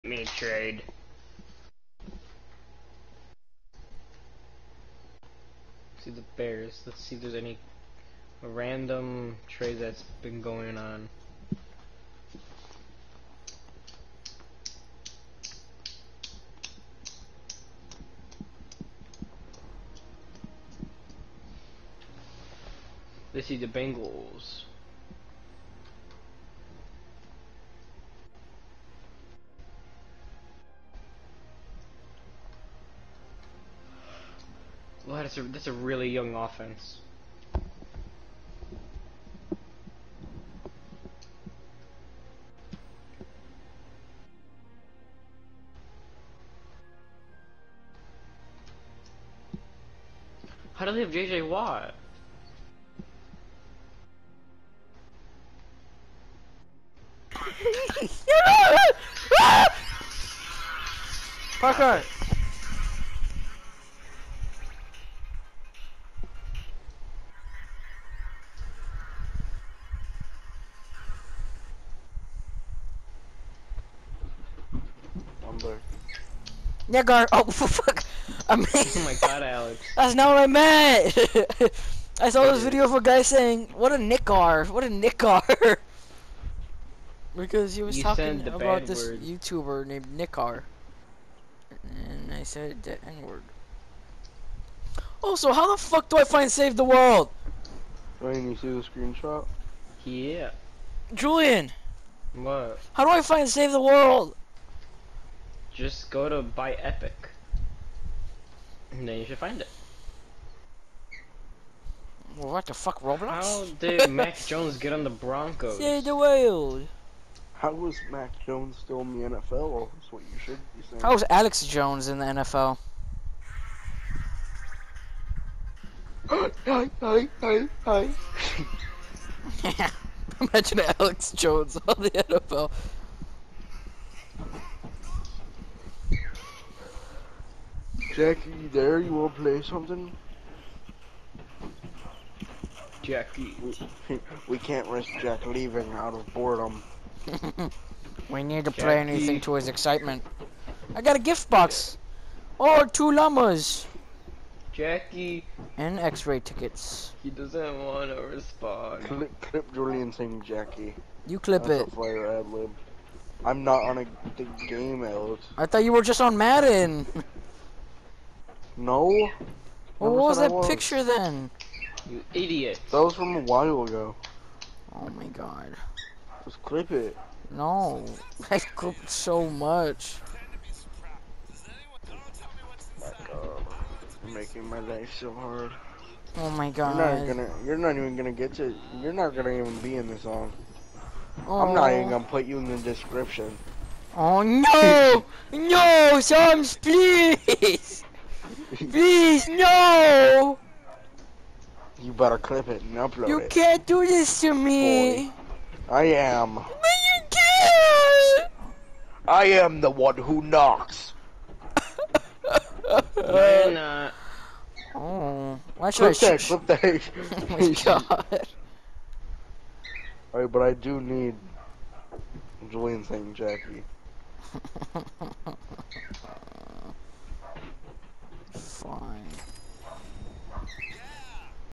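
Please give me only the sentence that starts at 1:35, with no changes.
Also, how the fuck do I find Save the World?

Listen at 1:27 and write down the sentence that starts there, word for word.
because he was you talking about this word.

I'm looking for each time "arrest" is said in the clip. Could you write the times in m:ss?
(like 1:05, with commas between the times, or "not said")
not said.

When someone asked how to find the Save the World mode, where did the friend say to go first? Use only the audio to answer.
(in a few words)
buy Epic.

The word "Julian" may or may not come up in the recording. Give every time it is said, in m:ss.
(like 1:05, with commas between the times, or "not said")
1:41, 2:39, 3:42.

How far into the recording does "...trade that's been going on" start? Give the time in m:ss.
0:09.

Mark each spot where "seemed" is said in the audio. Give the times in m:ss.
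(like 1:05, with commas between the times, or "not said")
not said.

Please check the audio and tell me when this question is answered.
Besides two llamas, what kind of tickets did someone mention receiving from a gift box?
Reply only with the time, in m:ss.
2:35.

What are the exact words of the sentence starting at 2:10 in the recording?
Imagine Alex Jones on the NFL.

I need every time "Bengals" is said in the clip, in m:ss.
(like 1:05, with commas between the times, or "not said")
0:23.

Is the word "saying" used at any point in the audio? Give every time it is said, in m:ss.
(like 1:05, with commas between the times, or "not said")
1:23, 2:00, 2:40, 3:43.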